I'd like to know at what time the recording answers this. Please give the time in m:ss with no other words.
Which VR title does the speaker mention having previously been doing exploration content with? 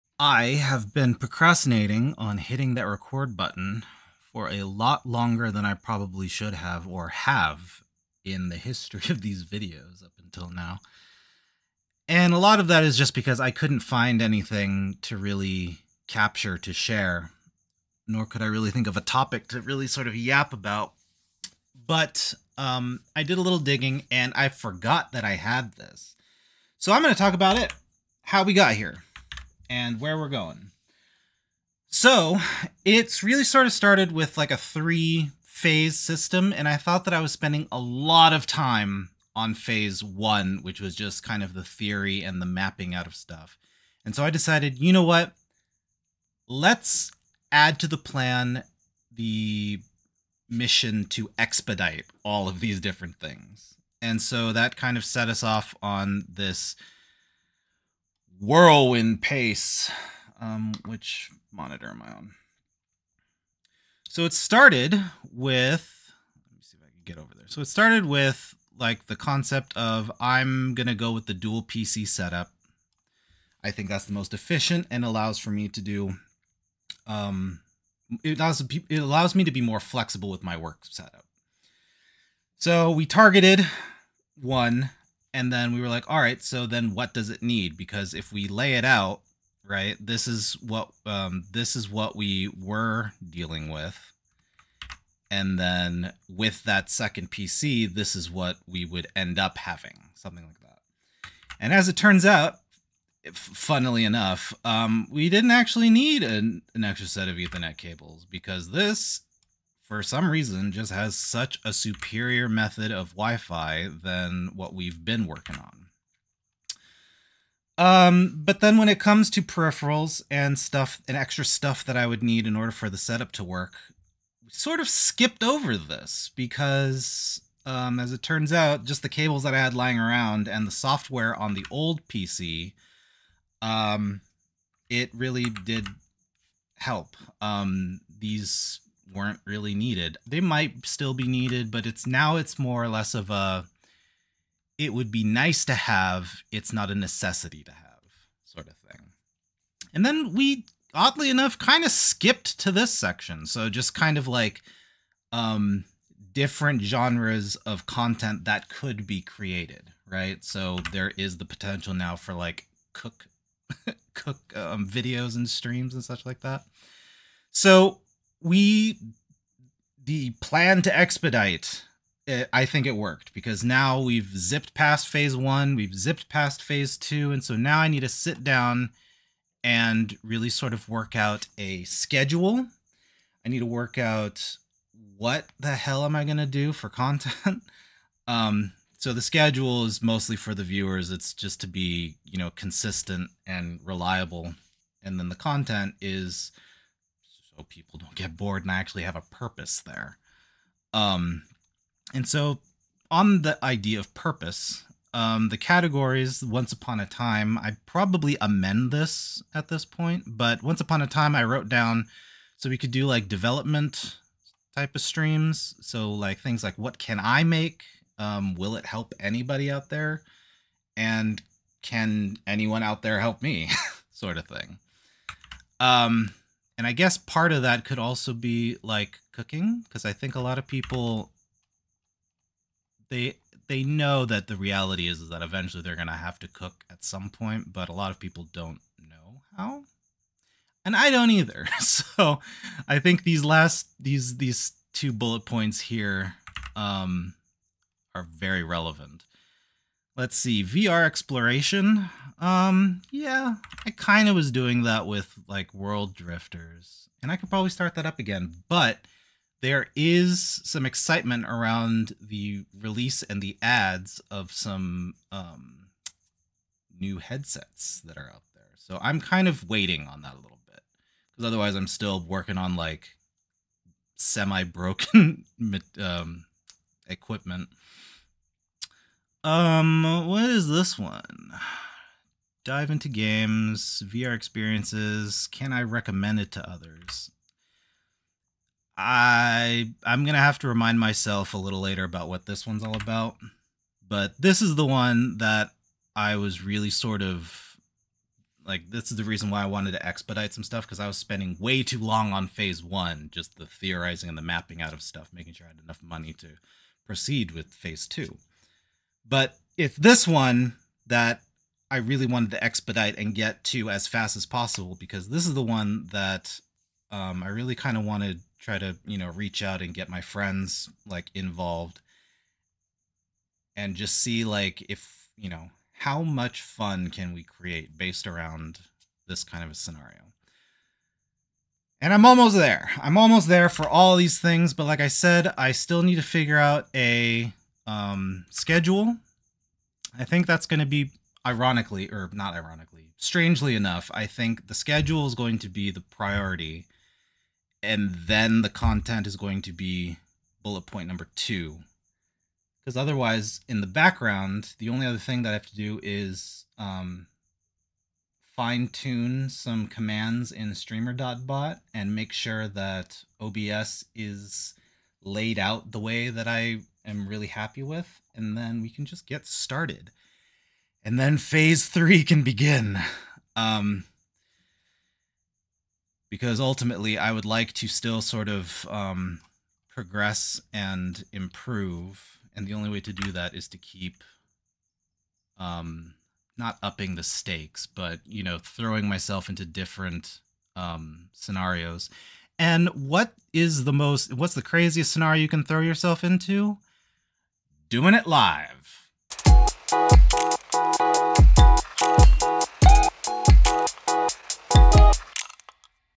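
4:15.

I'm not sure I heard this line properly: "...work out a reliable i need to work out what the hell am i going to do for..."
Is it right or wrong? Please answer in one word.
wrong.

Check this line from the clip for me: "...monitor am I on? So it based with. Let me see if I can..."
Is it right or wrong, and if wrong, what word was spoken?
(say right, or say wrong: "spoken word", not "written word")
wrong: "started", not "based".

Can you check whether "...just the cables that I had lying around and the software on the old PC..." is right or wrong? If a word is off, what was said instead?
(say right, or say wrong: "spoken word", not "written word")
right.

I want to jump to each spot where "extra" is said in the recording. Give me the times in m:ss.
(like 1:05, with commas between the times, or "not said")
1:46, 2:01.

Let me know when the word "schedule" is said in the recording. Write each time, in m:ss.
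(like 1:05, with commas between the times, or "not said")
3:01, 3:09, 5:38, 5:44.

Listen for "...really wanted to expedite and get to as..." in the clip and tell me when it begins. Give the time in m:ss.
5:11.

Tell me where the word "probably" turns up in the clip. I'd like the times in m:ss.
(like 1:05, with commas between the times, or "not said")
0:05, 3:27, 4:17.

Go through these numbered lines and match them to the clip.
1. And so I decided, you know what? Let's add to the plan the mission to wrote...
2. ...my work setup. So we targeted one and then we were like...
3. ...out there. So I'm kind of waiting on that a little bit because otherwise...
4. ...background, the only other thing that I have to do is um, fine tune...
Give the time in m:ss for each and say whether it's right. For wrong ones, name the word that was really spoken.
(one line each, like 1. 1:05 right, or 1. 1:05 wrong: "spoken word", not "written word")
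1. 0:44 wrong: "expedite", not "wrote"
2. 1:20 right
3. 4:28 right
4. 5:53 right.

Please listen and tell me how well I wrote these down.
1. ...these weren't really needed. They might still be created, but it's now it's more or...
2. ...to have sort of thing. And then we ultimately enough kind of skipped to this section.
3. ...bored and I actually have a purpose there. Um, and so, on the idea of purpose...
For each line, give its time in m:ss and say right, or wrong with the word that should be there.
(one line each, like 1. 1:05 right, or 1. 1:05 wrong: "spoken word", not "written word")
1. 2:18 wrong: "needed", not "created"
2. 2:27 wrong: "oddly", not "ultimately"
3. 3:18 right.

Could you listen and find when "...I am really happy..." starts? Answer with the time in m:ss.
6:06.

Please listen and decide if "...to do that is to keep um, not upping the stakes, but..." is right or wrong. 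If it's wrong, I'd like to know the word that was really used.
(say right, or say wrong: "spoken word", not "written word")
right.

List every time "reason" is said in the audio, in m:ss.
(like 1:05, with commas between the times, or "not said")
1:50, 4:59.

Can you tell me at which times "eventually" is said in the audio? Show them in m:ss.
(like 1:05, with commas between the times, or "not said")
3:55.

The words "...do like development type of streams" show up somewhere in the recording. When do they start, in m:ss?
3:32.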